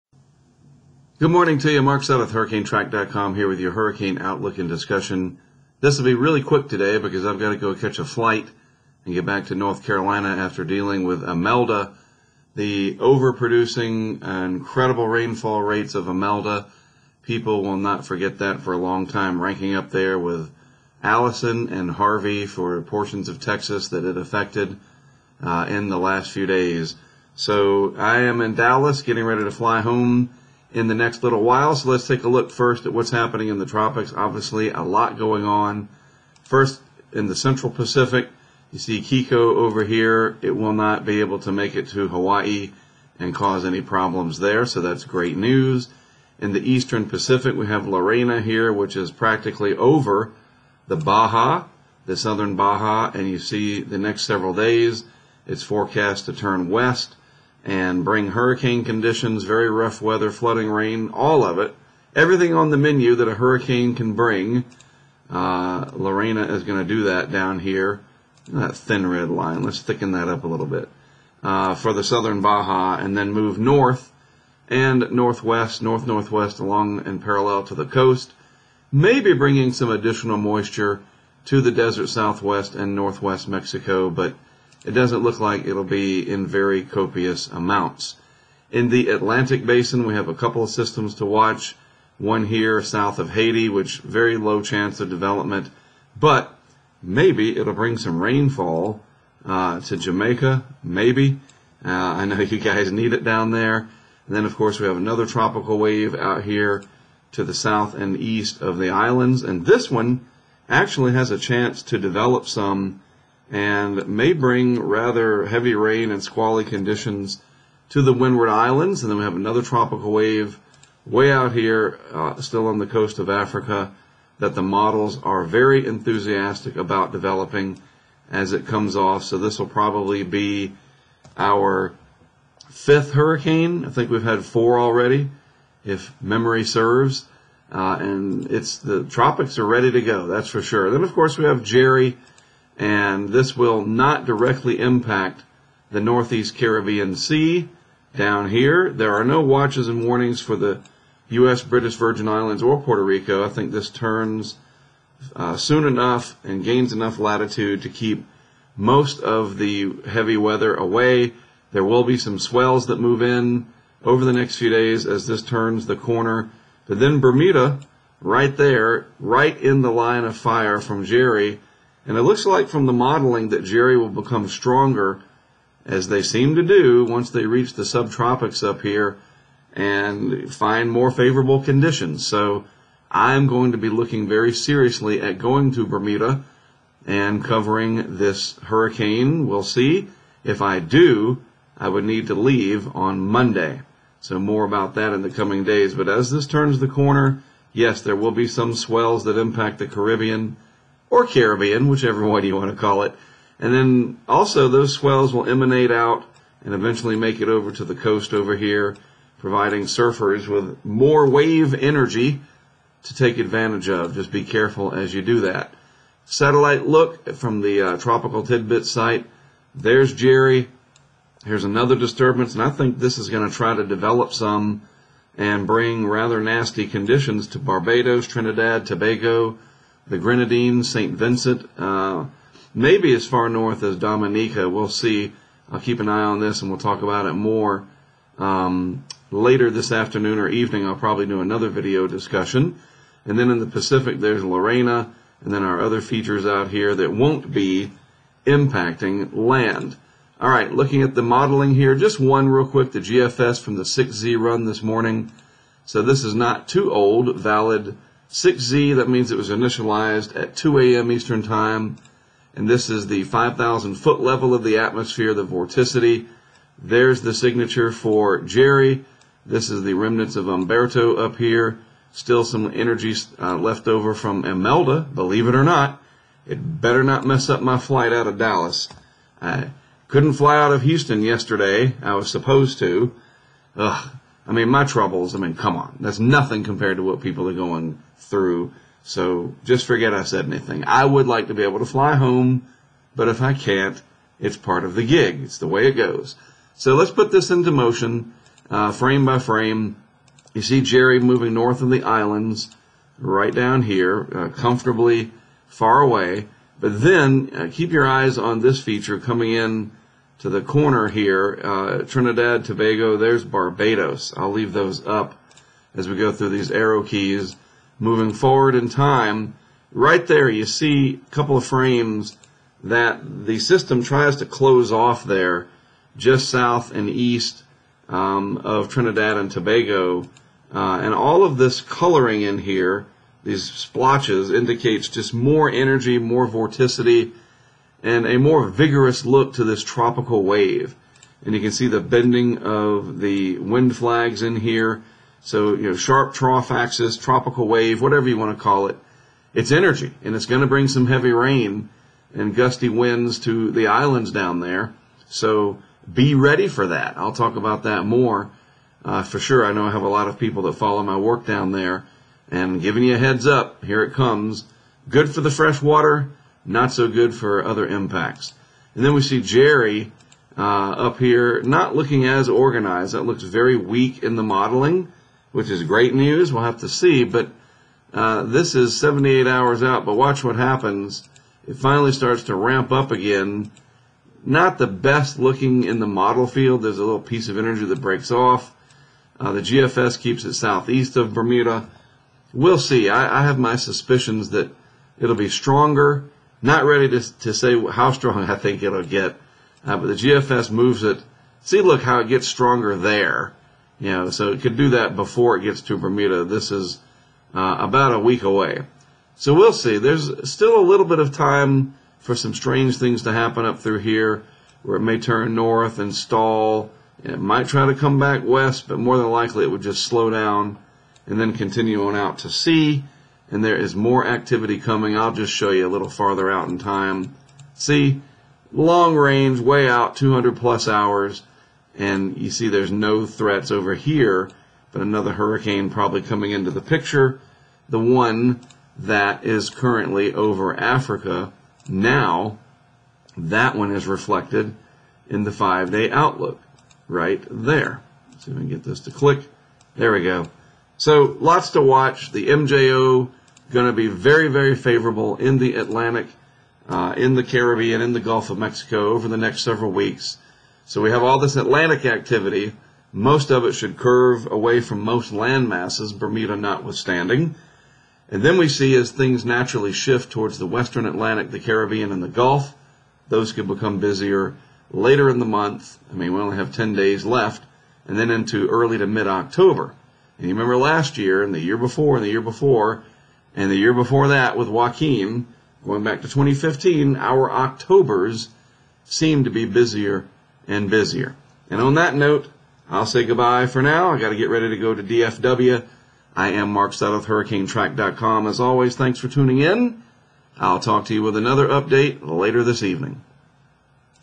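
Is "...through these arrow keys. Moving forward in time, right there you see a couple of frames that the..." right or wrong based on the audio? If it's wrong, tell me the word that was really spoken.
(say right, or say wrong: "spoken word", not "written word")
right.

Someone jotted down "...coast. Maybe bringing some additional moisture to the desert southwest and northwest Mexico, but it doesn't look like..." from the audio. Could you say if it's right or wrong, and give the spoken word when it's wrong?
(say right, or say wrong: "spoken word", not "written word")
right.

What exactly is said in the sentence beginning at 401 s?
See, look how it gets stronger there.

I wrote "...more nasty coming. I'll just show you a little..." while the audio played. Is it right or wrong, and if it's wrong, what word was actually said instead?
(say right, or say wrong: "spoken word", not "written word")
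wrong: "activity", not "nasty".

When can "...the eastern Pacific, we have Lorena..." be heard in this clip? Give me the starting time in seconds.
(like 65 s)
46 s.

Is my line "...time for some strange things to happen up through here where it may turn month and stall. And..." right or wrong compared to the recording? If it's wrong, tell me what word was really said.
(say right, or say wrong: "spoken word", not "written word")
wrong: "north", not "month".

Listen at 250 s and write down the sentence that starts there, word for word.
All right, looking at the modeling here, just one real quick, the GFS from the 6Z run this morning.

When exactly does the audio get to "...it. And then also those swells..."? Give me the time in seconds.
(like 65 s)
203 s.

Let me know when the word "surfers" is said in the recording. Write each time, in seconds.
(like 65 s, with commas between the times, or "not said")
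209 s.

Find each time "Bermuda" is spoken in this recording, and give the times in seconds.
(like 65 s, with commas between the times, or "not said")
167 s, 185 s, 391 s, 405 s, 466 s.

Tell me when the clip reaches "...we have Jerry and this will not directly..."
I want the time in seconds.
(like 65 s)
141 s.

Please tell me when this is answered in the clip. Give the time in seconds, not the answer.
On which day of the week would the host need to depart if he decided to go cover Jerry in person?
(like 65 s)
193 s.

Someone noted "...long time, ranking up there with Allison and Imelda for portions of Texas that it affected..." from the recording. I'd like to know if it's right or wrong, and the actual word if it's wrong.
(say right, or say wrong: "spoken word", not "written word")
wrong: "Harvey", not "Imelda".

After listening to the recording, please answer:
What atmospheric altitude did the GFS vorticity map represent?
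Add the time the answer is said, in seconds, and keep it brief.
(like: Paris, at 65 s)
5,000 feet, at 263 s.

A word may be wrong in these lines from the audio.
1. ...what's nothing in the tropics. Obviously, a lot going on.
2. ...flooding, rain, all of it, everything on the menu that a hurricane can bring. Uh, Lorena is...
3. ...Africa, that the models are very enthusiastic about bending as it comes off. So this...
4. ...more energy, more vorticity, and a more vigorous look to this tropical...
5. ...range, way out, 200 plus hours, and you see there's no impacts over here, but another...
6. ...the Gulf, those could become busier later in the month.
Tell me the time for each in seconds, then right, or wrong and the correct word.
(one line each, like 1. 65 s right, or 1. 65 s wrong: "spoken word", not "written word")
1. 32 s wrong: "happening", not "nothing"
2. 60 s right
3. 123 s wrong: "developing", not "bending"
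4. 335 s right
5. 429 s wrong: "threats", not "impacts"
6. 472 s right.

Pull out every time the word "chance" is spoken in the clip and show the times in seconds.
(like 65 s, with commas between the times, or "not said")
94 s, 111 s.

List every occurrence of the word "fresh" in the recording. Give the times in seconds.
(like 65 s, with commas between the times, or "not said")
365 s.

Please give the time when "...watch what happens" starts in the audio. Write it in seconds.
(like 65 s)
380 s.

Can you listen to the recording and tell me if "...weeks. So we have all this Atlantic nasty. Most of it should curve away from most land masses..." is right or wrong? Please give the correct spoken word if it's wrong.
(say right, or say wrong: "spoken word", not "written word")
wrong: "activity", not "nasty".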